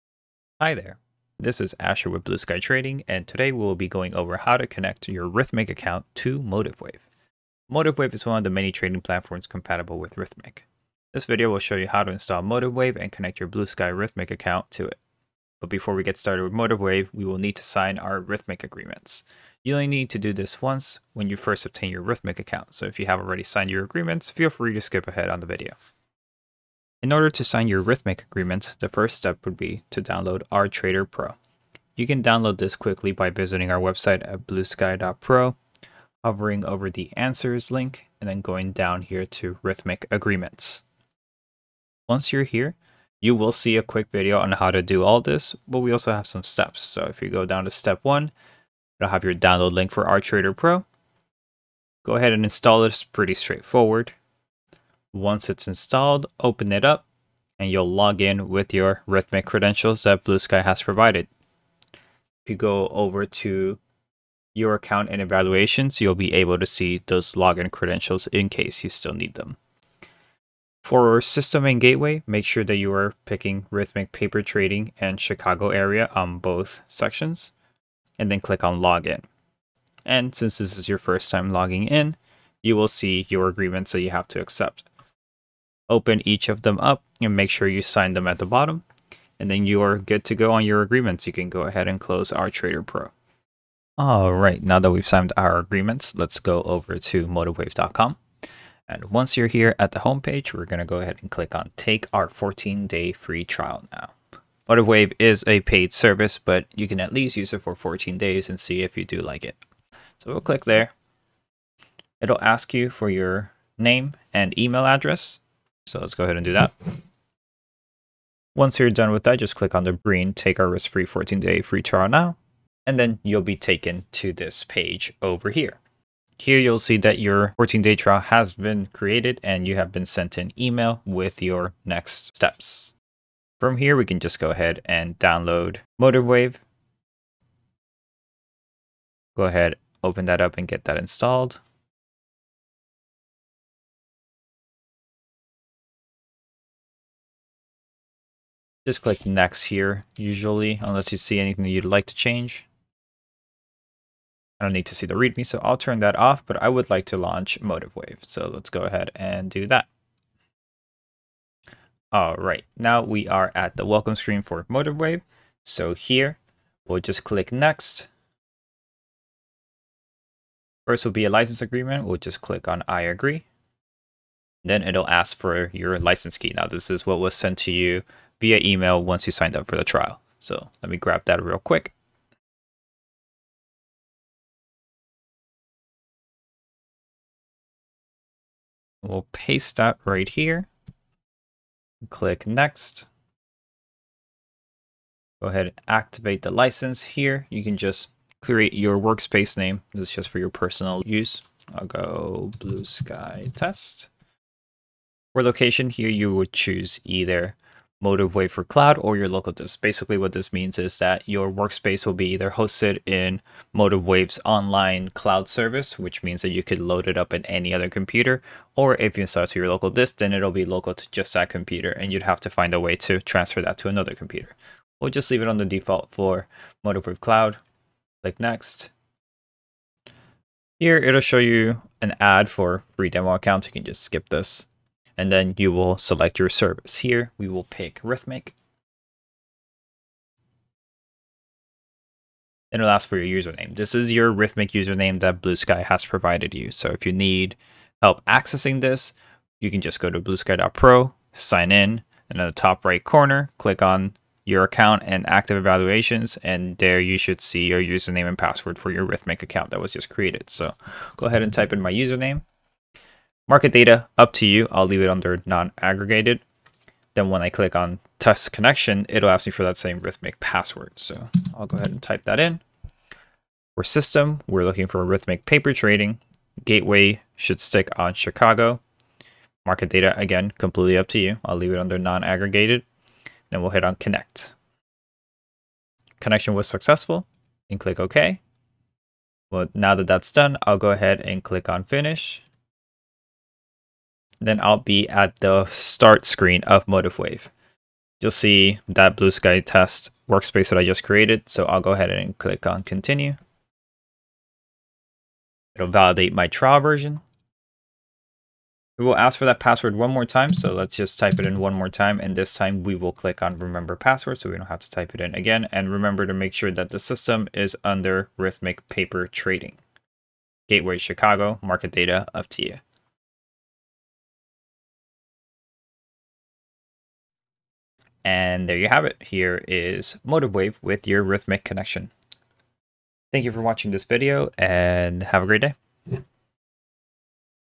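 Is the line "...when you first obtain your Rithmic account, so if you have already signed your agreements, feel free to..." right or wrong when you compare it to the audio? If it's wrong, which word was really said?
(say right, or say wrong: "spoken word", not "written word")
right.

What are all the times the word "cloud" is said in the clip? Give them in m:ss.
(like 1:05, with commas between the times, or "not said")
3:28, 3:35, 3:47.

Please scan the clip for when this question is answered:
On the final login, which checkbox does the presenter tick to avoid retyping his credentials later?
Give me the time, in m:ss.
5:13.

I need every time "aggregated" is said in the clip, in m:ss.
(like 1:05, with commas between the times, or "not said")
4:25, 4:41.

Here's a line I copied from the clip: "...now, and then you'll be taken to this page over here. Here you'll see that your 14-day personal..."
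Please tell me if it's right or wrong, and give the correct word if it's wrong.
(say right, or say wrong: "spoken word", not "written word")
wrong: "trial", not "personal".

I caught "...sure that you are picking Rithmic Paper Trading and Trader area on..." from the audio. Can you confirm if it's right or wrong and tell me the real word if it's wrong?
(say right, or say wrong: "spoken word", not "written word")
wrong: "Chicago", not "Trader".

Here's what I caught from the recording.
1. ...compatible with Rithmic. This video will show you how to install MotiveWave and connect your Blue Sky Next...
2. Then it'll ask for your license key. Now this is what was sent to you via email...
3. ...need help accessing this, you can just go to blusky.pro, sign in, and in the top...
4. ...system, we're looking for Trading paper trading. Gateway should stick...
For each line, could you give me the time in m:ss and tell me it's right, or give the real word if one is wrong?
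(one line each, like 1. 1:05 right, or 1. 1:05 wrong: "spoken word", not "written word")
1. 0:09 wrong: "Rithmic", not "Next"
2. 2:54 right
3. 4:07 right
4. 4:33 wrong: "Rithmic", not "Trading".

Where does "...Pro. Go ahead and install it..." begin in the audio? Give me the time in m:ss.
0:50.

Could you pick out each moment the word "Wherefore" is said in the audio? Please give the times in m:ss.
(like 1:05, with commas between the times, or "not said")
not said.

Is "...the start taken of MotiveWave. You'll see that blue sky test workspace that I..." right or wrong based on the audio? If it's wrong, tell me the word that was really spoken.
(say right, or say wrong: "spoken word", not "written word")
wrong: "screen", not "taken".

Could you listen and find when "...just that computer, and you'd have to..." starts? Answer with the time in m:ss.
3:41.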